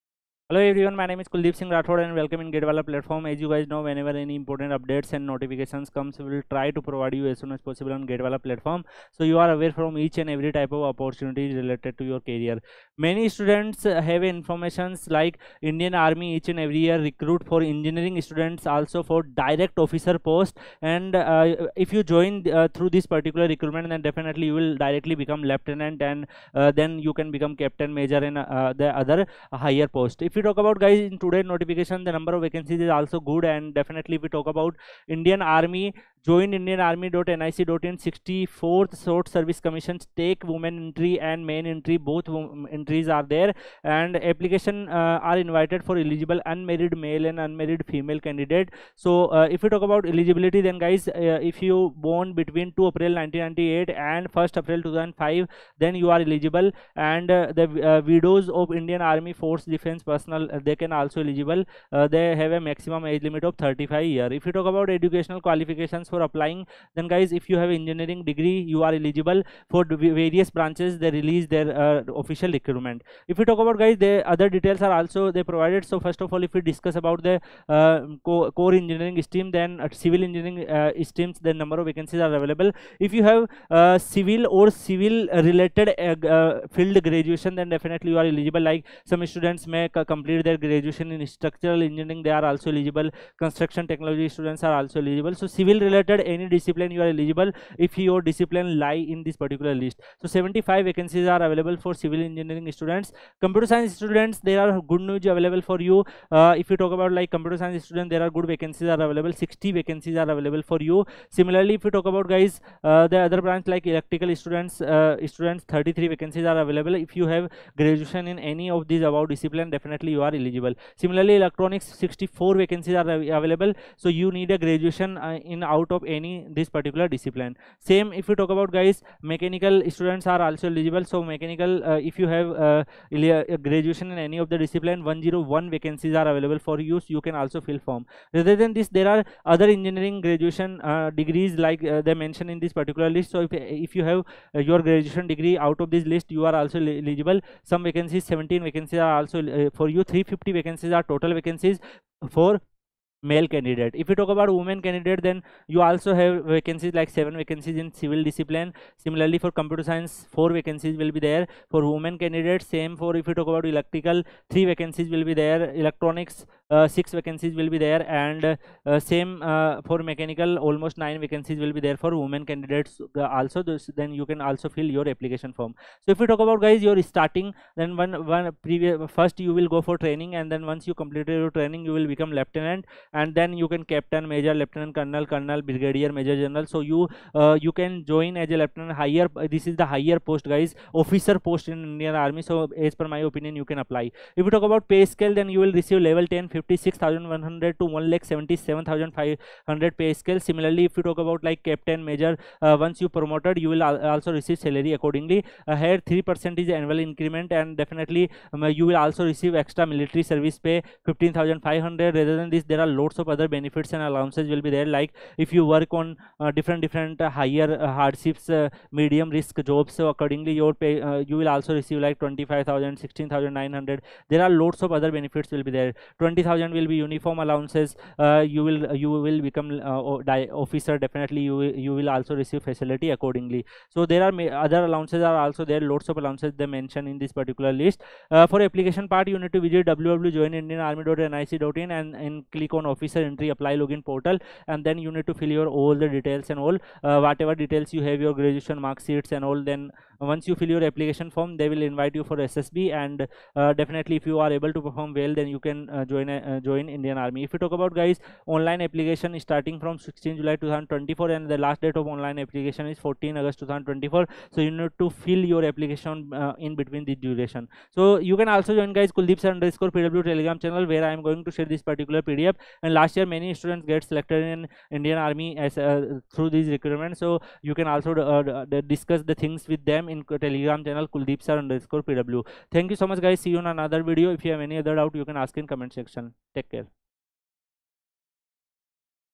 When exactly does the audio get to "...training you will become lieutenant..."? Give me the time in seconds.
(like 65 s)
181 s.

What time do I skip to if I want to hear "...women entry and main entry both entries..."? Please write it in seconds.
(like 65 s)
40 s.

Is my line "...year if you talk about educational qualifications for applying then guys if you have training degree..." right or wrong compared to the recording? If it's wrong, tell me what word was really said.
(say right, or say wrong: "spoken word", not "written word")
wrong: "engineering", not "training".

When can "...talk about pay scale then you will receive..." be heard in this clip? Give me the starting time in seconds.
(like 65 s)
194 s.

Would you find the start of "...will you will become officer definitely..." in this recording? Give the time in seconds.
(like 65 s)
228 s.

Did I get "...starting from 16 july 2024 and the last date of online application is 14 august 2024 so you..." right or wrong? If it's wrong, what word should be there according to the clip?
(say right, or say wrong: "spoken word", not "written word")
right.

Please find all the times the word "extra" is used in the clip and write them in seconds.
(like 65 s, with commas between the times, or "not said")
209 s.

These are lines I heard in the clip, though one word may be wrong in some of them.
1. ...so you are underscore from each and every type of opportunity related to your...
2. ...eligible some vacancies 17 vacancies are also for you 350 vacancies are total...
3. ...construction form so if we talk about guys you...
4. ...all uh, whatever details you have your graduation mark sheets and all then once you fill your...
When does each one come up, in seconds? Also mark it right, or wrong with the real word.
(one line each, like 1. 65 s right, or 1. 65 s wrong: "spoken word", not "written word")
1. 9 s wrong: "aware", not "underscore"
2. 146 s right
3. 175 s wrong: "application", not "construction"
4. 246 s right.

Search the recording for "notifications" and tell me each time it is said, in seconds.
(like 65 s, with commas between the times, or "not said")
5 s, 31 s.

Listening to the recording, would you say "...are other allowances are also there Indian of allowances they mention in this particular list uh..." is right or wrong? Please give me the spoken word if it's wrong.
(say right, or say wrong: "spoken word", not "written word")
wrong: "Loads", not "Indian".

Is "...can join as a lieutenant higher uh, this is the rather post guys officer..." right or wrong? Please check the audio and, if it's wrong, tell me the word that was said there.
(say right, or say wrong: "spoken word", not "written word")
wrong: "higher", not "rather".